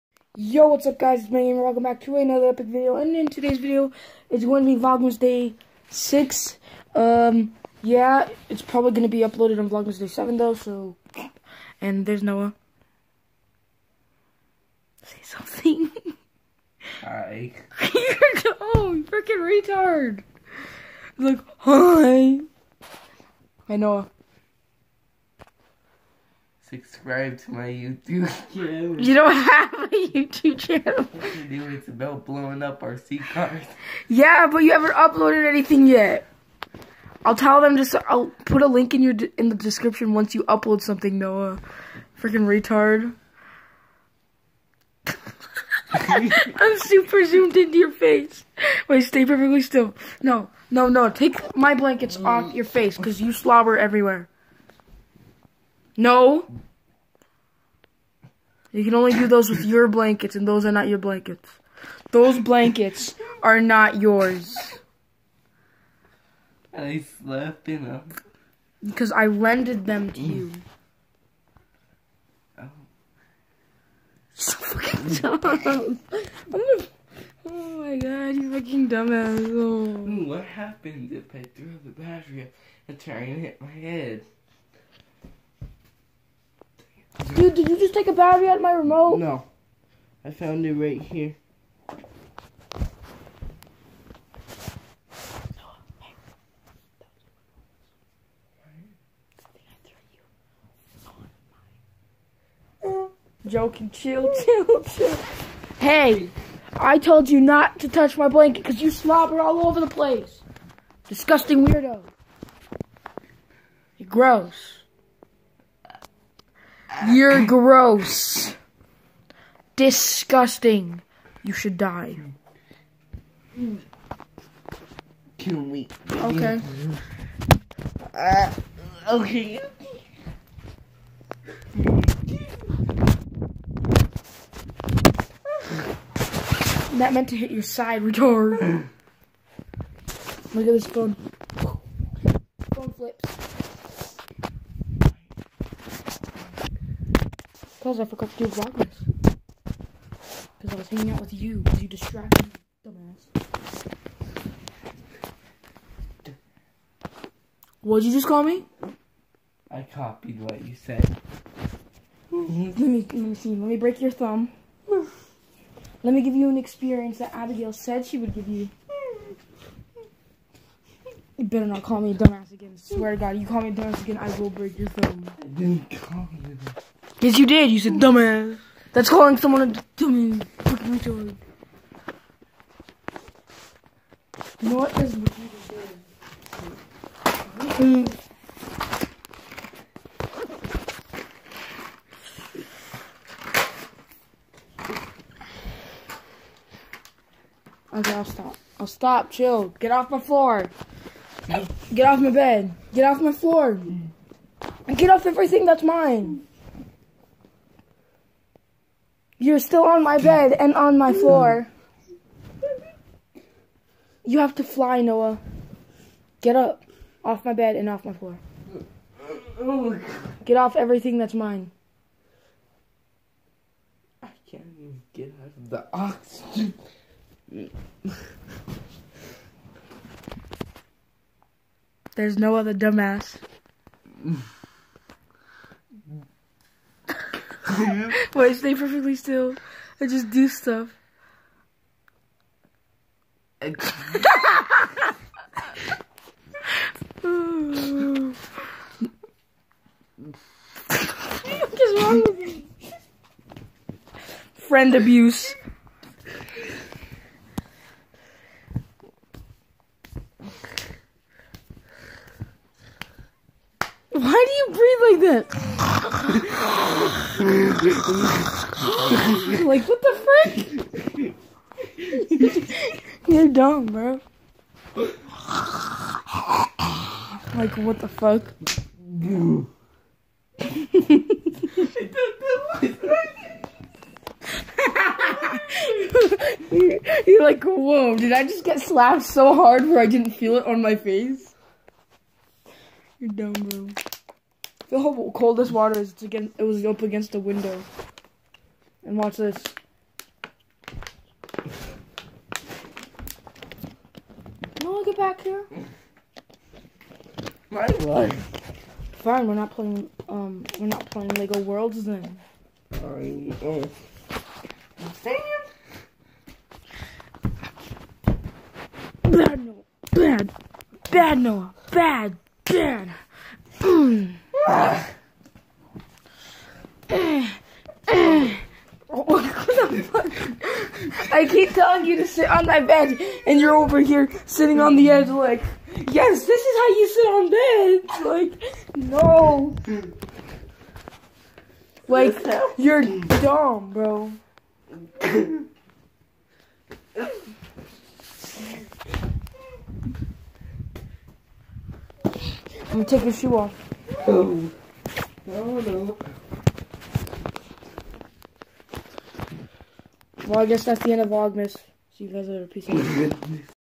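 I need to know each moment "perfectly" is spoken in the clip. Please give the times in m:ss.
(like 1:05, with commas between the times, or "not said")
0:49, 3:58.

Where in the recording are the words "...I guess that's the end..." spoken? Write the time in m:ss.
6:00.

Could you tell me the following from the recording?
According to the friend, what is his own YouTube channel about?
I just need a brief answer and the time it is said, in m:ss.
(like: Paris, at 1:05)
Blowing up RC cars, at 0:32.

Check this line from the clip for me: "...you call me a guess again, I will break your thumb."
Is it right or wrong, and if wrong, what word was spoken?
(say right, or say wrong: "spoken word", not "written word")
wrong: "dumbass", not "guess".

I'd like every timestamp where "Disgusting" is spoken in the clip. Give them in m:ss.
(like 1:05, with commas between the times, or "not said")
1:51, 1:59.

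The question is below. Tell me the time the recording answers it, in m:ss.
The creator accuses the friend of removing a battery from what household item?
1:28.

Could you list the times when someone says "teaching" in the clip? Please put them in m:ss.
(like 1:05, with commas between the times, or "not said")
not said.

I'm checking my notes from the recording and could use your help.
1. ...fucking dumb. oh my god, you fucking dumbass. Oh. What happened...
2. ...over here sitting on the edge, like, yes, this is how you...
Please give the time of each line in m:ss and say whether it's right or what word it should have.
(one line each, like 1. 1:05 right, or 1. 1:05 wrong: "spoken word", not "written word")
1. 1:14 right
2. 5:33 right.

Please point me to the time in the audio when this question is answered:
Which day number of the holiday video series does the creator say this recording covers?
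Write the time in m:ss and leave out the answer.
0:04.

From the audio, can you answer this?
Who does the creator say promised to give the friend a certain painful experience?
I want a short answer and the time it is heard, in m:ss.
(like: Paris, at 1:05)
Abigail, at 2:47.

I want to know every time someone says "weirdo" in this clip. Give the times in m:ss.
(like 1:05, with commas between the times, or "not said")
1:51.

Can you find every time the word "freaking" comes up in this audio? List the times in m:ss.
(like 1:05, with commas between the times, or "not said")
0:19, 0:42.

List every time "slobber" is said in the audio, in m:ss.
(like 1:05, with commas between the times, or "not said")
0:53, 1:48.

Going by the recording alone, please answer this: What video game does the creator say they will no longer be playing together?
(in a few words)
Lego Worlds.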